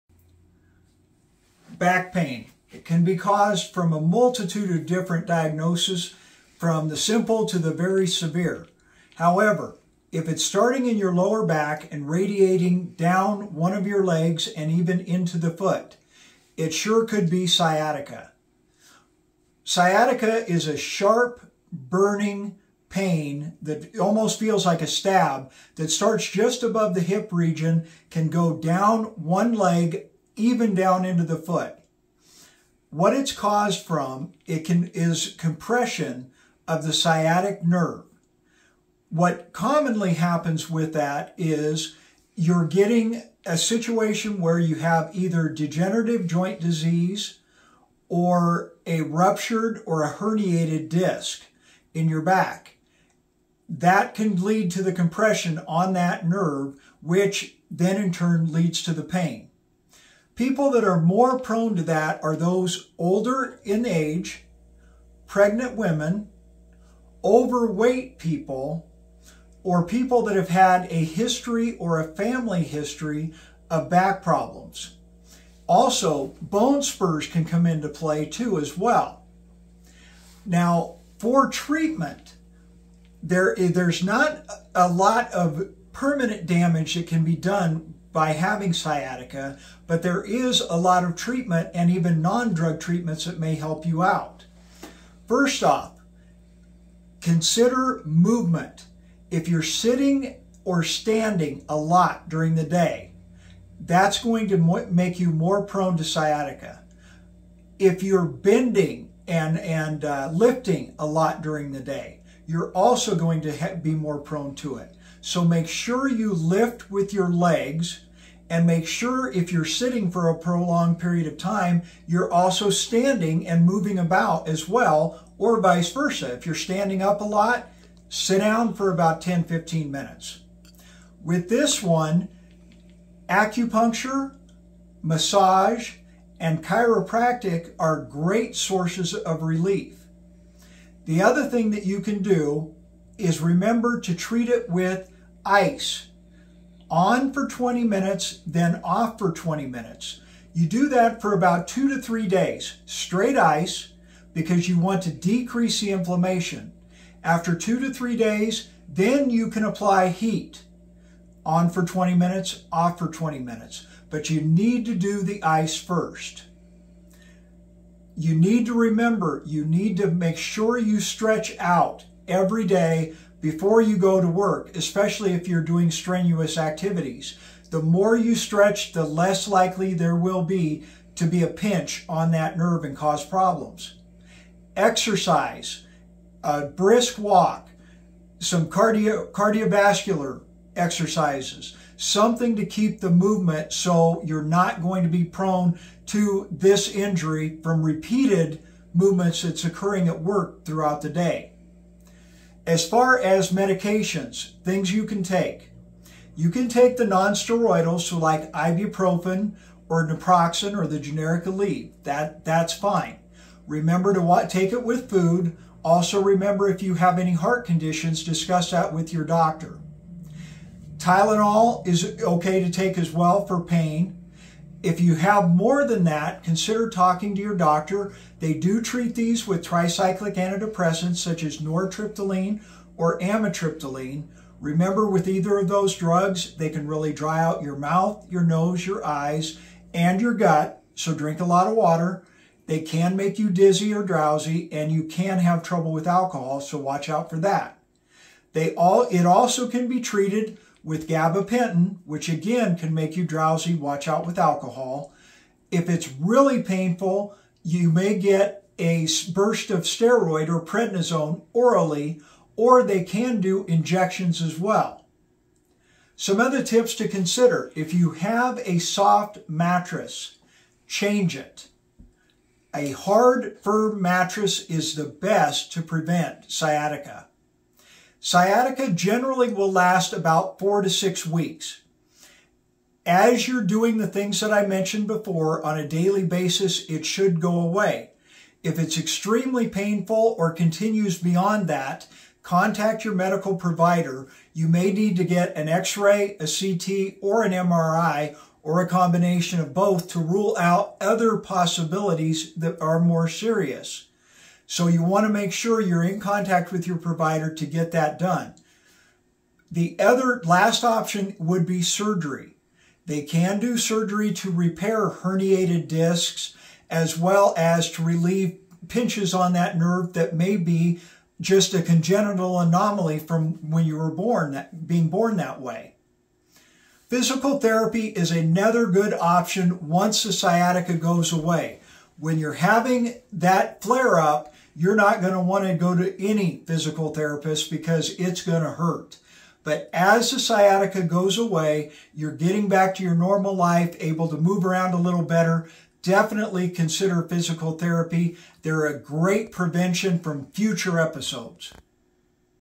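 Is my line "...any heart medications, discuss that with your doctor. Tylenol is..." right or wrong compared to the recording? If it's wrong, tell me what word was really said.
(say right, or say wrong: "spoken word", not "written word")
wrong: "conditions", not "medications".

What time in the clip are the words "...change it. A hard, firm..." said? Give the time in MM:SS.
04:30.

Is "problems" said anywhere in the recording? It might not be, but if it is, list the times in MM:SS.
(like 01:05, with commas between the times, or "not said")
01:14, 03:03.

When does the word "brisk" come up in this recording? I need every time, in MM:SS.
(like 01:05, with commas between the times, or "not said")
03:06.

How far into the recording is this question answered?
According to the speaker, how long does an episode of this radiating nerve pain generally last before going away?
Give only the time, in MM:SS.
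04:40.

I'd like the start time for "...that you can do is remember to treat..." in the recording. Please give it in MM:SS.
02:21.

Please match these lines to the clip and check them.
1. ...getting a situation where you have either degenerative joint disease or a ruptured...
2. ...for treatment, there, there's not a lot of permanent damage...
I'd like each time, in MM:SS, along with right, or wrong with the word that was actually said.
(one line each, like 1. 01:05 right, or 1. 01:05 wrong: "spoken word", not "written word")
1. 00:42 right
2. 01:21 right.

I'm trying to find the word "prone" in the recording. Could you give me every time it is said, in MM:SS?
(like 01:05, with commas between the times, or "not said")
01:01, 01:45, 01:54, 03:15.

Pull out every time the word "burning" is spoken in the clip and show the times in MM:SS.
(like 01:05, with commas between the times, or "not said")
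00:21.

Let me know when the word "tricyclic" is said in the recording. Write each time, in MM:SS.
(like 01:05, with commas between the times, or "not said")
03:49.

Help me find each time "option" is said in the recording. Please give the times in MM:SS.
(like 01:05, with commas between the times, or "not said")
05:10, 05:29.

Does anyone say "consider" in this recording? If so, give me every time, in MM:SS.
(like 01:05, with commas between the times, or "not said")
01:37, 03:46, 04:27, 05:46.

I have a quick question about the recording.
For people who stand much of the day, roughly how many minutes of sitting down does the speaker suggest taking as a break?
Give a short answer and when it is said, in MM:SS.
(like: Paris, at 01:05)
10 to 15 minutes, at 02:09.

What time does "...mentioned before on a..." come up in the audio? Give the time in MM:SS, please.
04:44.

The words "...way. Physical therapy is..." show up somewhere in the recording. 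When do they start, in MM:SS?
05:25.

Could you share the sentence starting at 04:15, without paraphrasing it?
If it's really painful, you may get a burst of steroid or prednisone orally, or they can do injections as well.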